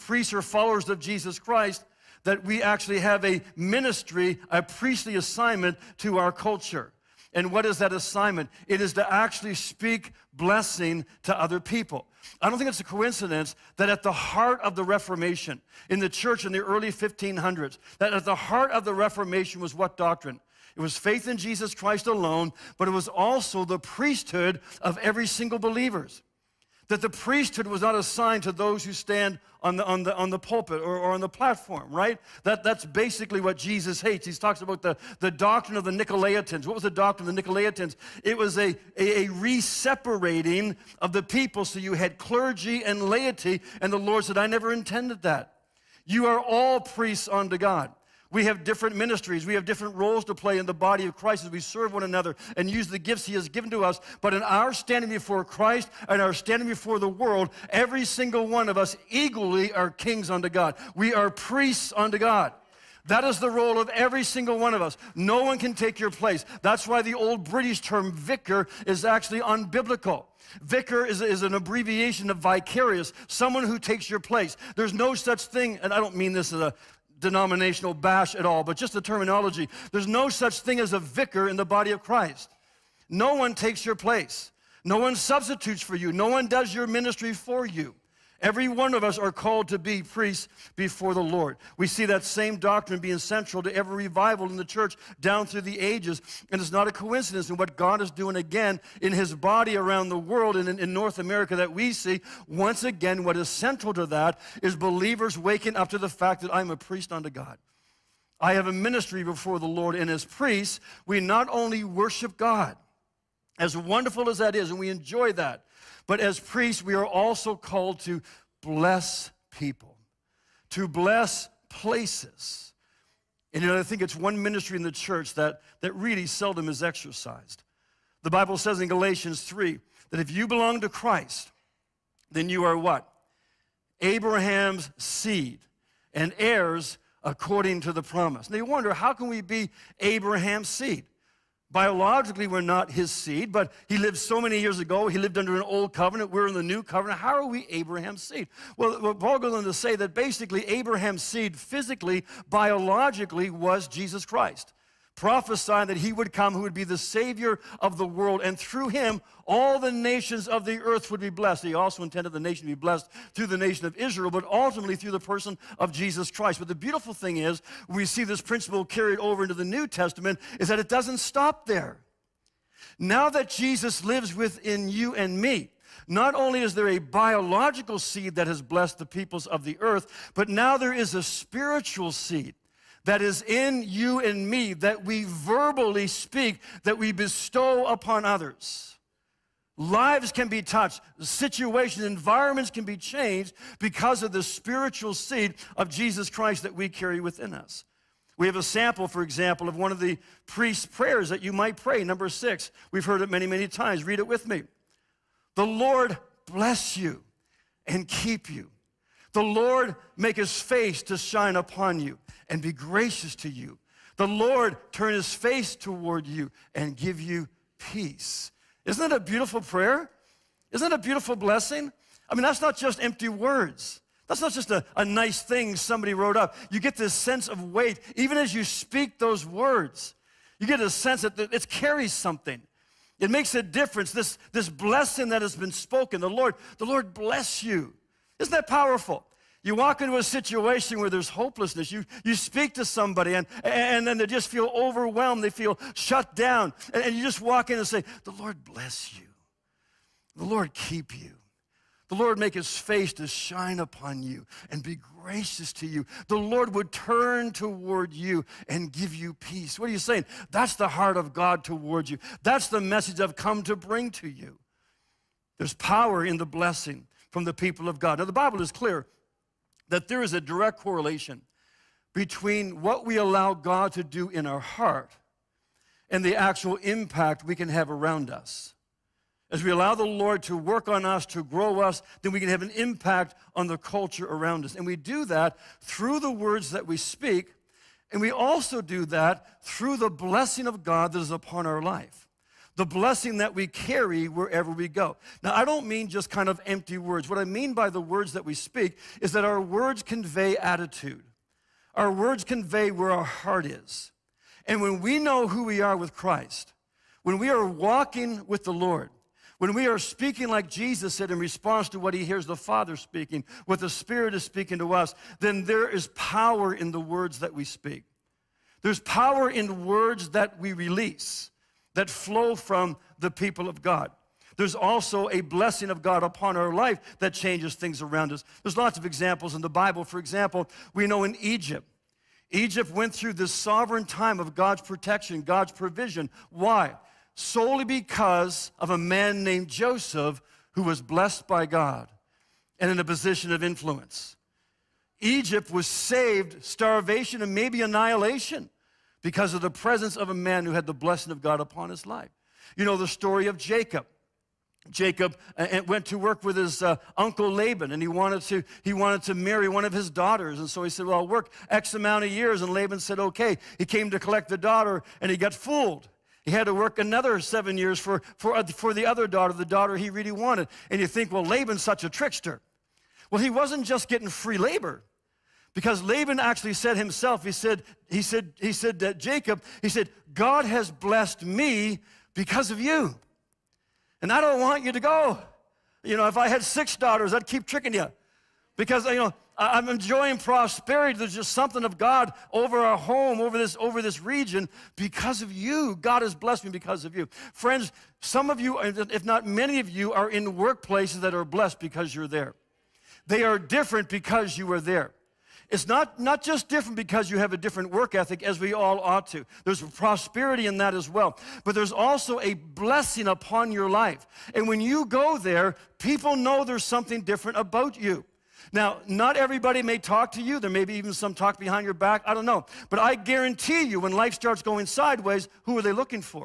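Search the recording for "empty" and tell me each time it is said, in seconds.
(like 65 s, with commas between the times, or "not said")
223 s, 296 s.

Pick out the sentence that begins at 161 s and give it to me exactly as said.
He also intended the nation to be blessed through the nation of Israel, but ultimately through the person of Jesus Christ.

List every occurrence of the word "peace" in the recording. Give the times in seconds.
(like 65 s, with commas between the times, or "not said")
217 s, 259 s.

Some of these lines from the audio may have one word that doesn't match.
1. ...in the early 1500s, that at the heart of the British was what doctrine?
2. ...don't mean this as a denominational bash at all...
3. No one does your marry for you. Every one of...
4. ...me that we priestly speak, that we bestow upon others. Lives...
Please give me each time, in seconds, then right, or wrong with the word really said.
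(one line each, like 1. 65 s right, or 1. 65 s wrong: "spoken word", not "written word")
1. 16 s wrong: "Reformation", not "British"
2. 75 s right
3. 86 s wrong: "ministry", not "marry"
4. 184 s wrong: "verbally", not "priestly".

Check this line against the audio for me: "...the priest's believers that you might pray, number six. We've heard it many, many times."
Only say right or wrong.
wrong.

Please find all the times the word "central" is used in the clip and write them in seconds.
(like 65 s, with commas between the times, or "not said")
93 s, 103 s.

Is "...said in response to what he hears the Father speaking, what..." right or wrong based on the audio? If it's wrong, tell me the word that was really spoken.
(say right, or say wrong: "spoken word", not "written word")
right.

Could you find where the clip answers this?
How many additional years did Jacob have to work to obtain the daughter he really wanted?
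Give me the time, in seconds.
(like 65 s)
367 s.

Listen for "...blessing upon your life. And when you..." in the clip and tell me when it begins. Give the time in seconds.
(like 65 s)
412 s.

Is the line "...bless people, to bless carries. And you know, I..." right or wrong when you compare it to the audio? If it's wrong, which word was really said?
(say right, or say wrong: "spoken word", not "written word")
wrong: "places", not "carries".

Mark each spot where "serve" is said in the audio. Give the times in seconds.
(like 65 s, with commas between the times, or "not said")
51 s.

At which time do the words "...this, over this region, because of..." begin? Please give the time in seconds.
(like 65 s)
393 s.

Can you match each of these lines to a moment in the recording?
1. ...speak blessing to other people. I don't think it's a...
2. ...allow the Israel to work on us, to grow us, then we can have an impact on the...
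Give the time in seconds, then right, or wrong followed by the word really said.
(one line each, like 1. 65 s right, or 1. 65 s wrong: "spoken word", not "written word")
1. 9 s right
2. 279 s wrong: "Lord", not "Israel".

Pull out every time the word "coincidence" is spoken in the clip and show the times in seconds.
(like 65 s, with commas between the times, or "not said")
12 s, 96 s.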